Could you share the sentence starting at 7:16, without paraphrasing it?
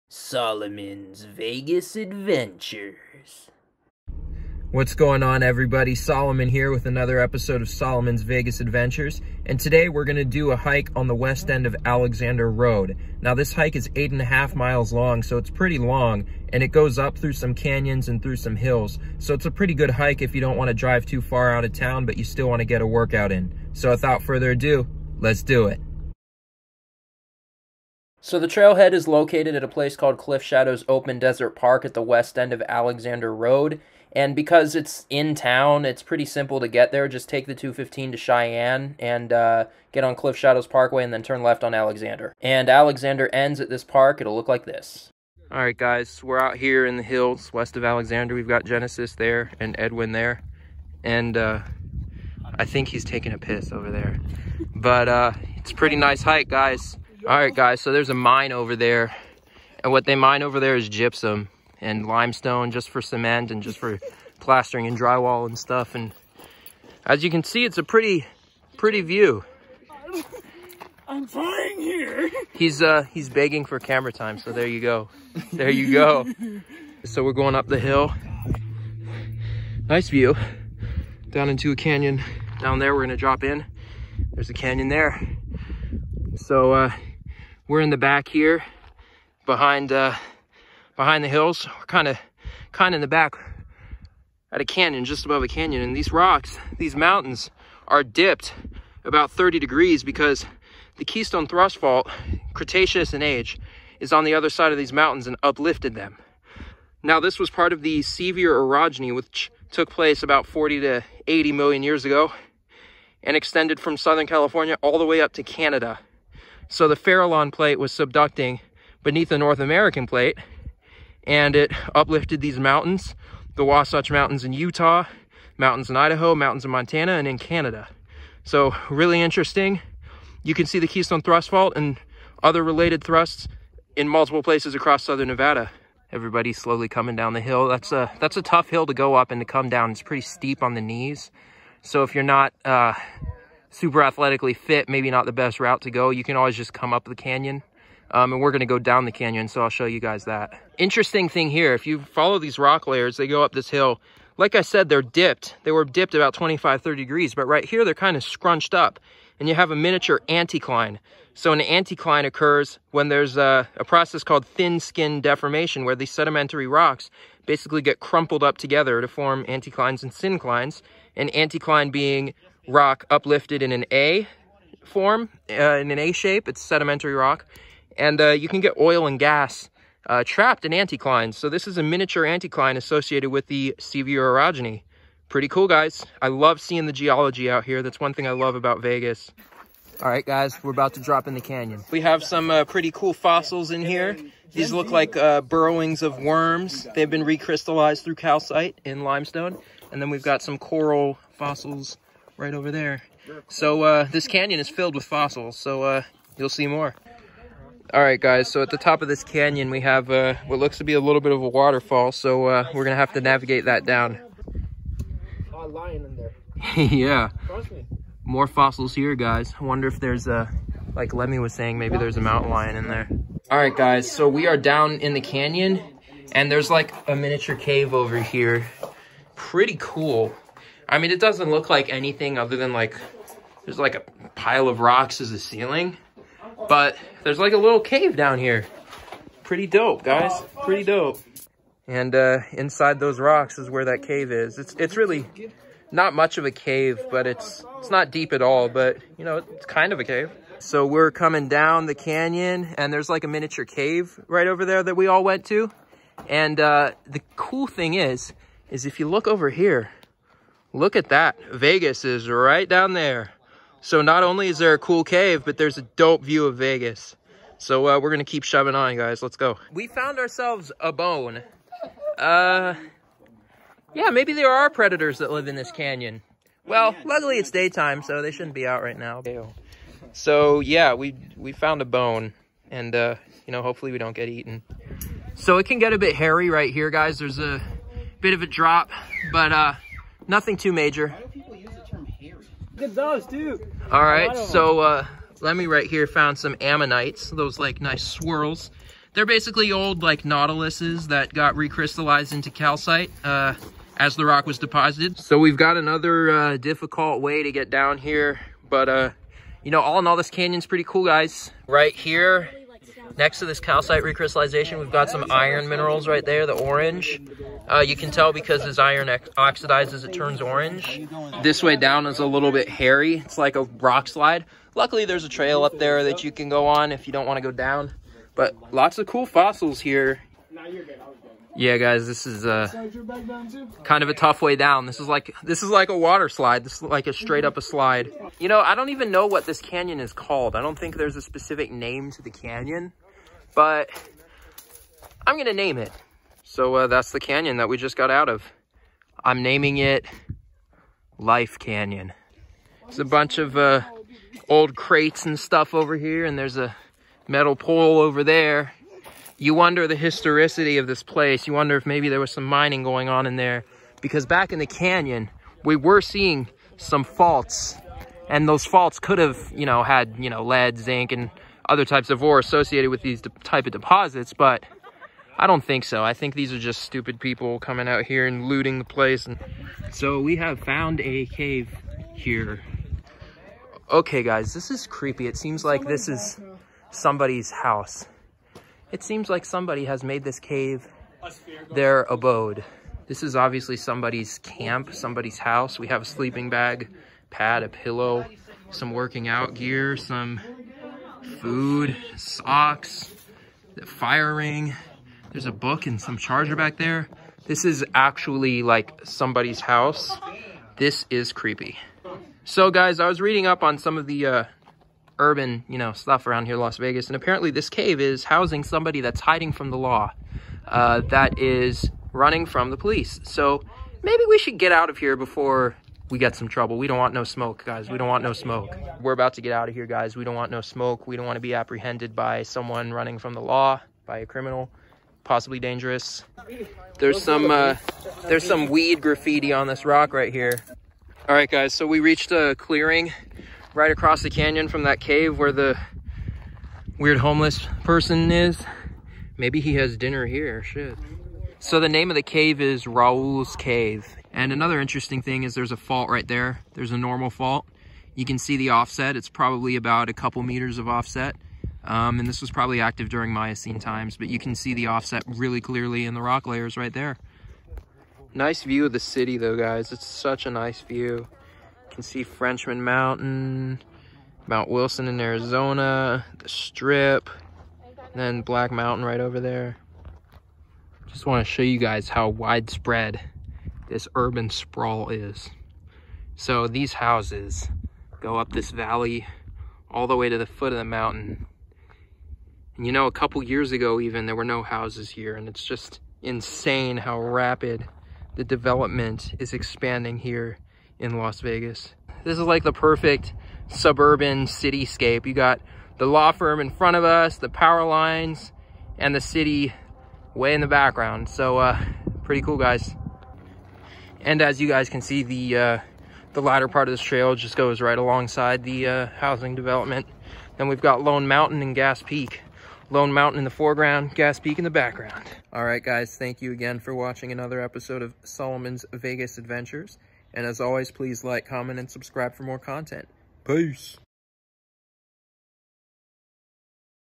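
There's some uh, there's some weed graffiti on this rock right here.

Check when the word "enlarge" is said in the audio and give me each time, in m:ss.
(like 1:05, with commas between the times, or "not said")
not said.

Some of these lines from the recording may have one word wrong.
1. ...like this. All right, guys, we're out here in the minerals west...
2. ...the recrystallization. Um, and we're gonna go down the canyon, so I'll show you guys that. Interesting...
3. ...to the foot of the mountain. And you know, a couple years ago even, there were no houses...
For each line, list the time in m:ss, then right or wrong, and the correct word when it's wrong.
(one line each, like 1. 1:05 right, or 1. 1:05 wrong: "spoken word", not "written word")
1. 0:44 wrong: "hills", not "minerals"
2. 2:27 wrong: "canyon", not "recrystallization"
3. 8:10 right.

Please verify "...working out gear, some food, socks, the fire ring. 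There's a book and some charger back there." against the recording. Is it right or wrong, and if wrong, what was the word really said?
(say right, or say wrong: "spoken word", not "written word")
right.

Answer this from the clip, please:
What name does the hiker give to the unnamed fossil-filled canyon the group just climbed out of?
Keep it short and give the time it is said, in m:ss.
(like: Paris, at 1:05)
Life Canyon, at 5:51.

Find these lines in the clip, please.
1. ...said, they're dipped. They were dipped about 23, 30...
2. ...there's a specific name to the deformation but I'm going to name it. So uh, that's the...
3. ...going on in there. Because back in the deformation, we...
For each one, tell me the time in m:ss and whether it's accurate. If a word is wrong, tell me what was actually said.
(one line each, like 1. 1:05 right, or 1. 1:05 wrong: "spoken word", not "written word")
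1. 2:34 wrong: "25", not "23"
2. 5:40 wrong: "canyon", not "deformation"
3. 6:02 wrong: "canyon", not "deformation".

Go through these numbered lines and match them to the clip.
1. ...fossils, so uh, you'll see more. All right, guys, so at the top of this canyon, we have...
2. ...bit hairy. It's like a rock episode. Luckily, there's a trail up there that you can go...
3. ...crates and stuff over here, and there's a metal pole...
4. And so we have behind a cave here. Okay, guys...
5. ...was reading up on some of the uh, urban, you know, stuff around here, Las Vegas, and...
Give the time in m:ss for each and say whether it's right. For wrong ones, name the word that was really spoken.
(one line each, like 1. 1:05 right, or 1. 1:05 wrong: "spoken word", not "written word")
1. 3:25 right
2. 5:22 wrong: "slide", not "episode"
3. 5:54 right
4. 6:19 wrong: "found", not "behind"
5. 6:53 right.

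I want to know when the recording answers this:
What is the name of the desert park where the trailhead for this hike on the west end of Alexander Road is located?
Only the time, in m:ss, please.
0:30.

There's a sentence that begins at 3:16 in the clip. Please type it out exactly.
They've been recrystallized through calcite in limestone.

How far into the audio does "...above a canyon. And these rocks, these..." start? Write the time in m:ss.
1:35.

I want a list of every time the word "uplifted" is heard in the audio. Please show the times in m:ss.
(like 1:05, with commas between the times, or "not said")
1:45, 2:01, 2:53.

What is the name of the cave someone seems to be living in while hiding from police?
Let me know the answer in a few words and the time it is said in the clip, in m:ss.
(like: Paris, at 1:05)
Raoul's Cave, at 7:32.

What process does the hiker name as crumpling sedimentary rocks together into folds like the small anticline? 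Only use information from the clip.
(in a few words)
Thin skin deformation.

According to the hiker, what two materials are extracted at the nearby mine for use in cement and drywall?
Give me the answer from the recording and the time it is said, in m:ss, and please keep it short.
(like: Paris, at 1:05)
Gypsum and limestone, at 1:00.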